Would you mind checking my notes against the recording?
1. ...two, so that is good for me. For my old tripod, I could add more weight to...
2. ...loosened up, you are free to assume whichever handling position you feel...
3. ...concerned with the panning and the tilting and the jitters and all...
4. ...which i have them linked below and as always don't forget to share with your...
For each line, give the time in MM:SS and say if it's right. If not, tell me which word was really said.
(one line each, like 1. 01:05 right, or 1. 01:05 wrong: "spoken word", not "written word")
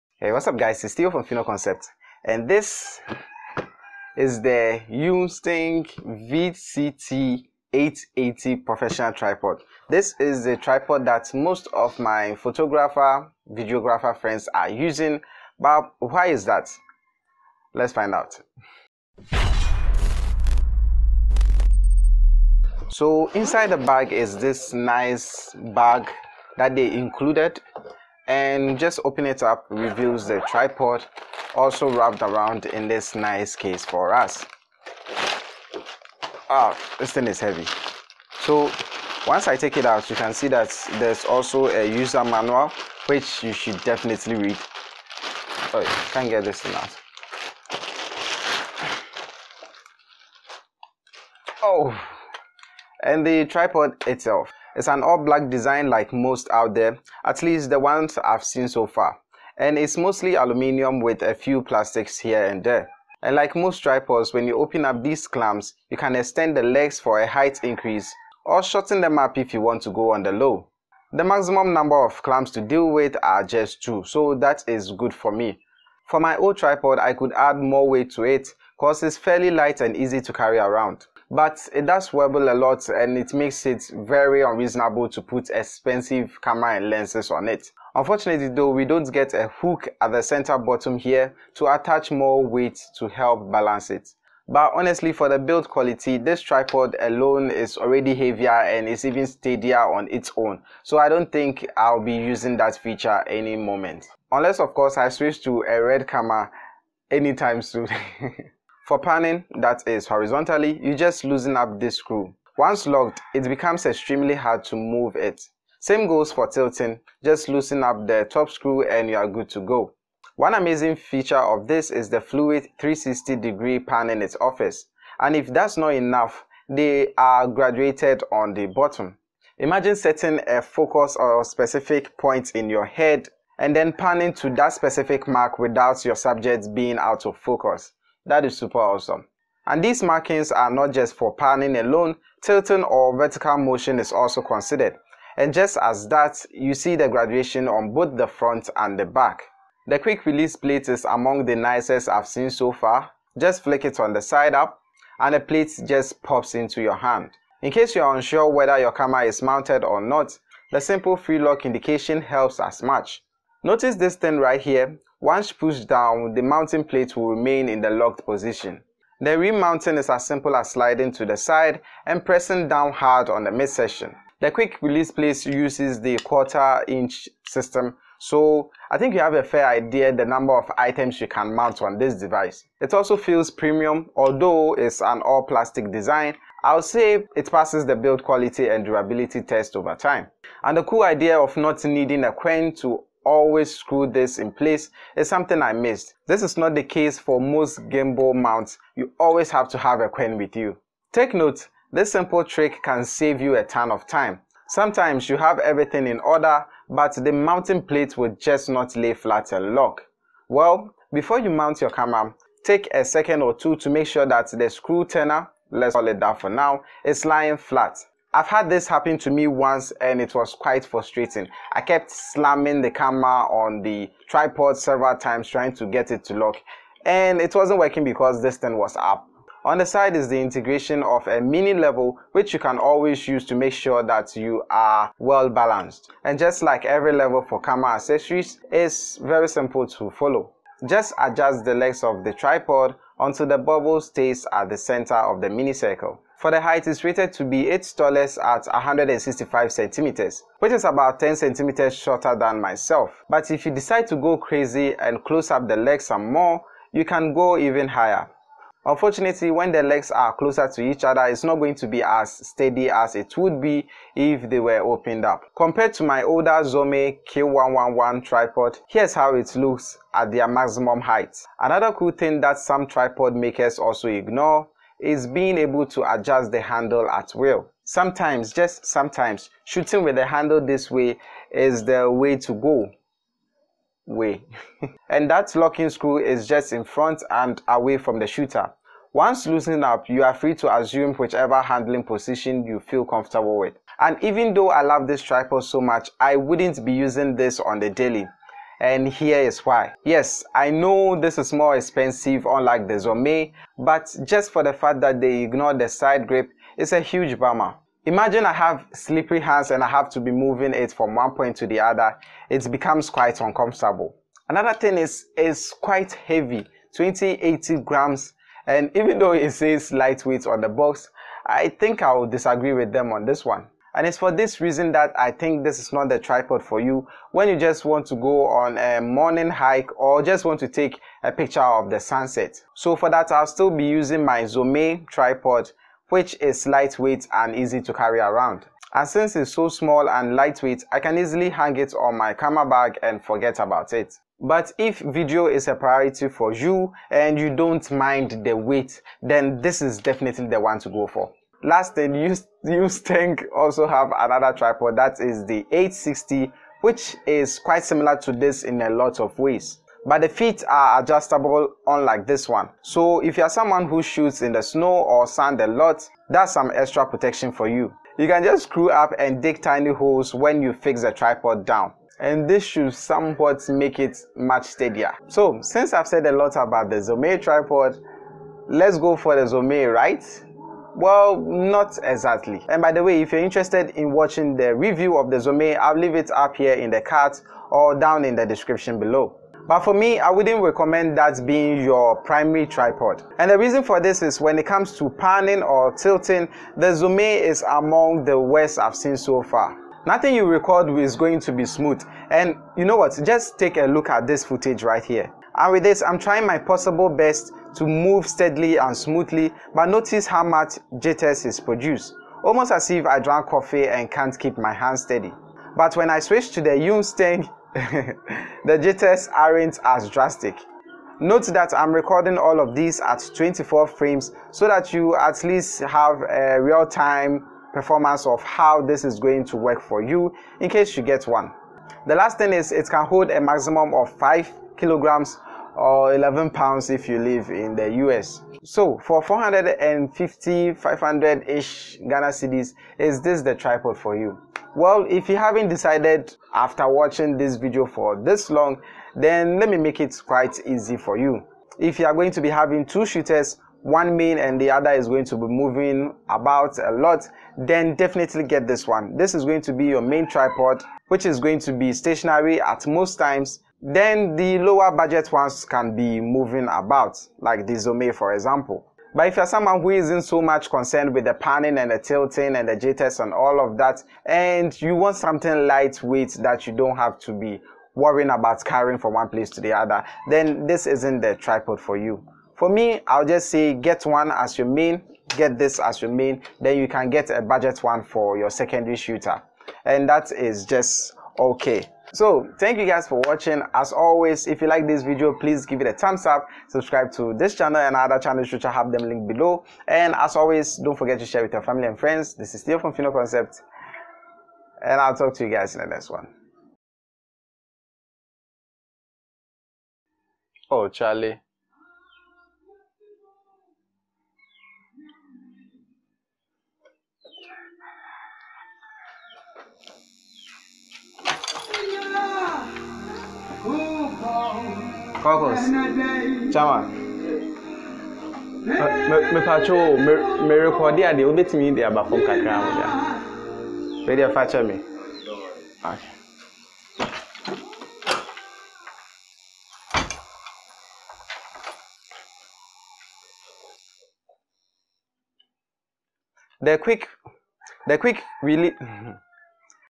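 1. 01:13 right
2. 04:49 right
3. 07:50 right
4. 08:18 right.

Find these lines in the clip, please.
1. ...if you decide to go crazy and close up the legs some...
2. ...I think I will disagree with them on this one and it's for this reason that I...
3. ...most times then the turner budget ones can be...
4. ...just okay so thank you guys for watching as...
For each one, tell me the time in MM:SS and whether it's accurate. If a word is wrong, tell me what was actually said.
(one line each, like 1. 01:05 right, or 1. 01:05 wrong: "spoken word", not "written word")
1. 04:13 right
2. 05:21 right
3. 07:42 wrong: "lower", not "turner"
4. 08:10 right.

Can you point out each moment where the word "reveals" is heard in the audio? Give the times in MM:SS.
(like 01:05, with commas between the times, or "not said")
00:29.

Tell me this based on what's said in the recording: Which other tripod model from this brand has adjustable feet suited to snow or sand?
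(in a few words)
860.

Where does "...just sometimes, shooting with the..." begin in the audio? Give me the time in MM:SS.
04:38.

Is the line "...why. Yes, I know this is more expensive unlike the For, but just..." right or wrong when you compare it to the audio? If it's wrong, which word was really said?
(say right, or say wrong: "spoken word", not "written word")
wrong: "Zomei", not "For".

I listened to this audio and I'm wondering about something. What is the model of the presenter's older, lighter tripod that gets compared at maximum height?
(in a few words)
Zomei Q111.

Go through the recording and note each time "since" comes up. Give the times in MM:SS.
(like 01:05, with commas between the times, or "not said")
05:39, 06:15.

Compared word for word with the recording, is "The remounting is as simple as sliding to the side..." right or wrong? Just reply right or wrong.
right.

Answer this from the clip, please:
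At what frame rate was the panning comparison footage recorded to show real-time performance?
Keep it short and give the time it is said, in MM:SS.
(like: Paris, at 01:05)
24 frames, at 07:03.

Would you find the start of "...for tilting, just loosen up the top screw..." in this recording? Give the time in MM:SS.
01:56.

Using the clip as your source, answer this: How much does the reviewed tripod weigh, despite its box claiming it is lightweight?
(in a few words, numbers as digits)
2080 grams.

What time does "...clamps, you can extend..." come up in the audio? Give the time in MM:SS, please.
01:05.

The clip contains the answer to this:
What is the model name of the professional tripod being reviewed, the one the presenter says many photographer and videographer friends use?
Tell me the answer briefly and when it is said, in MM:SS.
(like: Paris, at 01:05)
Yunteng VCT880, at 00:04.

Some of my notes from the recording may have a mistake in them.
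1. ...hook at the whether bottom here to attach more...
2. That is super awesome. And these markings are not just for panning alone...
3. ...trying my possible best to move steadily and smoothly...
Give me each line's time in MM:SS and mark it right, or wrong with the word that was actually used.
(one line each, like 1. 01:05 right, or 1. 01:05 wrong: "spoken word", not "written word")
1. 01:29 wrong: "center", not "whether"
2. 02:18 right
3. 06:46 right.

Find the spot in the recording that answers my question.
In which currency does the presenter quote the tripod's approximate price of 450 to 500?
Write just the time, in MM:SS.
07:22.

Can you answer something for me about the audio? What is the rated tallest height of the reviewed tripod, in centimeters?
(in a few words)
165 centimeters.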